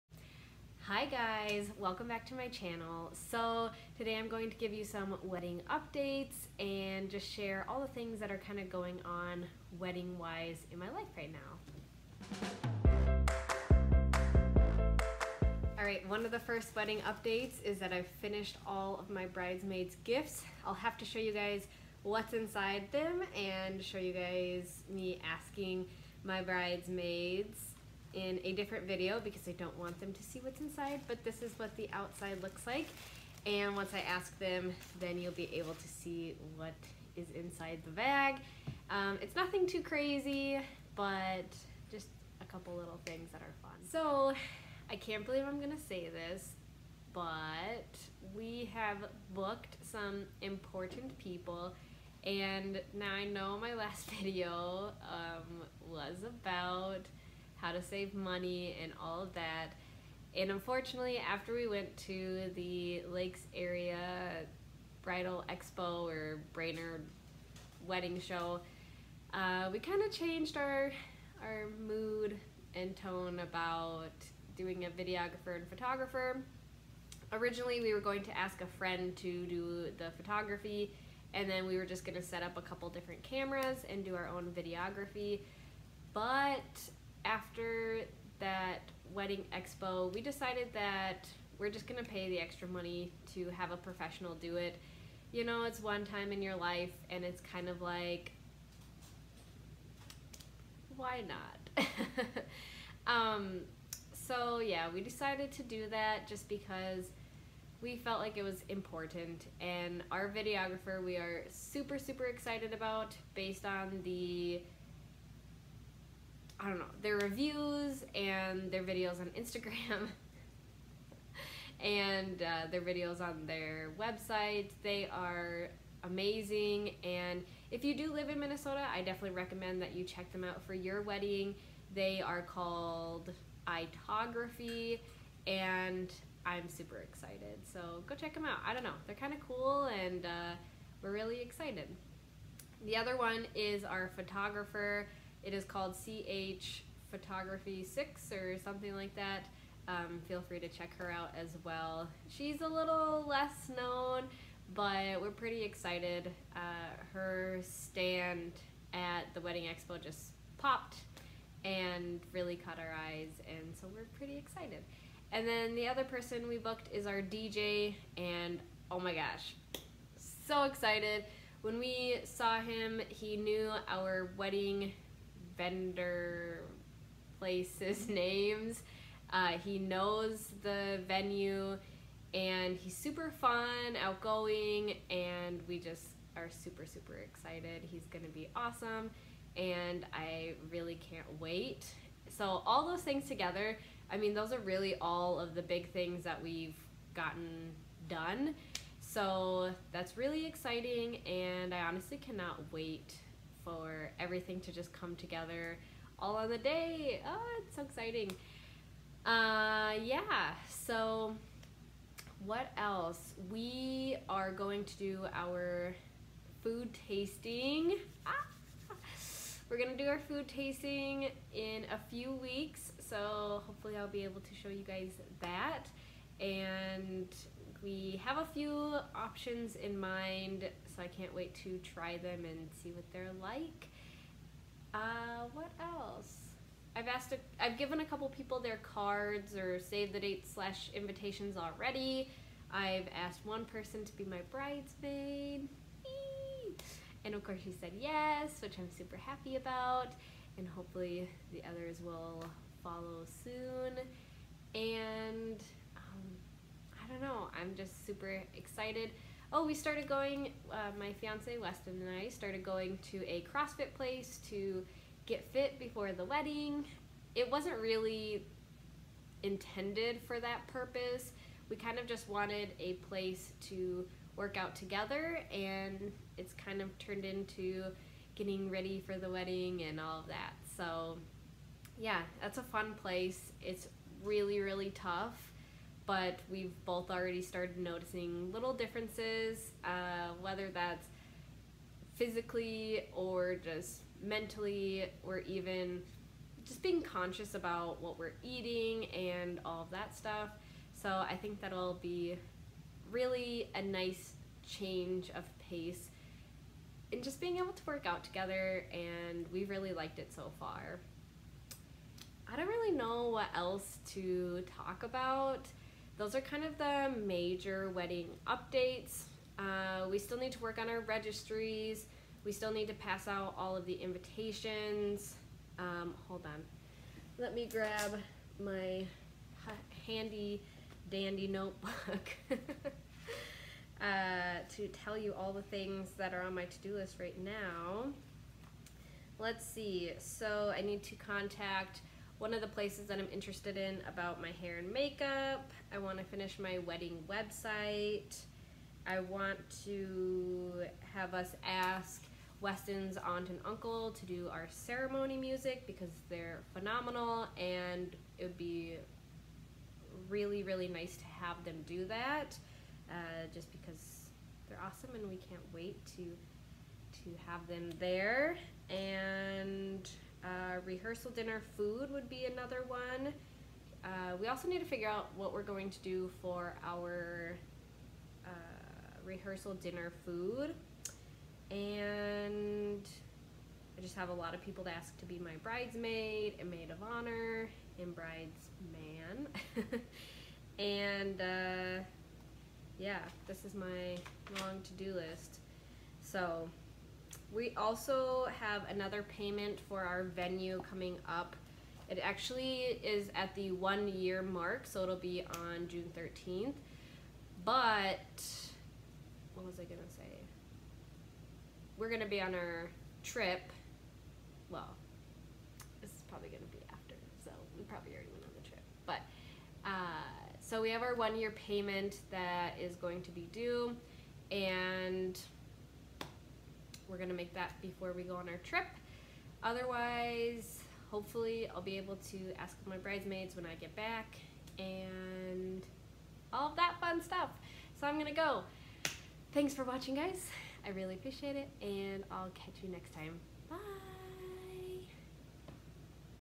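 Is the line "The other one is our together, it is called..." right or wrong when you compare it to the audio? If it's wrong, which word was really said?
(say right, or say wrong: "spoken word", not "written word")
wrong: "photographer", not "together".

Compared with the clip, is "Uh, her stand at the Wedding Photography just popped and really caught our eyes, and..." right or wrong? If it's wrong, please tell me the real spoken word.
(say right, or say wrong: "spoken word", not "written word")
wrong: "Expo", not "Photography".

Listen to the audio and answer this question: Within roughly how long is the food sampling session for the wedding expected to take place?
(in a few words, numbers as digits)
a few weeks.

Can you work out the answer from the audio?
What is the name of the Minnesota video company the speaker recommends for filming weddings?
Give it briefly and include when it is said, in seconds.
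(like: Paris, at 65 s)
Itography, at 133 s.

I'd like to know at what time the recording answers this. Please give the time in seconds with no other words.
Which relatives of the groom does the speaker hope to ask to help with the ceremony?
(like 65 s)
353 s.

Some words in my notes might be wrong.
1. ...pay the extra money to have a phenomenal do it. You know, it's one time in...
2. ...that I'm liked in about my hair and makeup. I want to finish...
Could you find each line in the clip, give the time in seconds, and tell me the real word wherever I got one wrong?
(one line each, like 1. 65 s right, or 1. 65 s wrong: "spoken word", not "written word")
1. 92 s wrong: "professional", not "phenomenal"
2. 343 s wrong: "interested", not "liked".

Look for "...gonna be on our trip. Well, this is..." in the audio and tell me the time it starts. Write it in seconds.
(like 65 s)
412 s.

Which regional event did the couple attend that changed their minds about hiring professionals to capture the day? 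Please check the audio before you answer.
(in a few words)
Lakes Area Bridal Expo.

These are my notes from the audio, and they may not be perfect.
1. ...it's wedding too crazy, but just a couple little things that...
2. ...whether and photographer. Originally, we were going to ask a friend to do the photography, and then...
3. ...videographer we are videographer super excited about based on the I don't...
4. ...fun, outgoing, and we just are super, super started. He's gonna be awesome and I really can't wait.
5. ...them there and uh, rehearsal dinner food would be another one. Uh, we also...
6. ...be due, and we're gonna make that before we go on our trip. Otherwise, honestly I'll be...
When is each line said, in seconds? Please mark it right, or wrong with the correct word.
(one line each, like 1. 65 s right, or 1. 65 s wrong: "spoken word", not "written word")
1. 39 s wrong: "nothing", not "wedding"
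2. 74 s wrong: "videographer", not "whether"
3. 110 s wrong: "super", not "videographer"
4. 183 s wrong: "excited", not "started"
5. 367 s right
6. 423 s wrong: "hopefully", not "honestly".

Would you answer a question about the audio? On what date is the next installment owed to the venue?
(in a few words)
June 13th.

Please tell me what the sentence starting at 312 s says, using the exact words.
I don't really know what else to talk about those are kind of the major wedding updates.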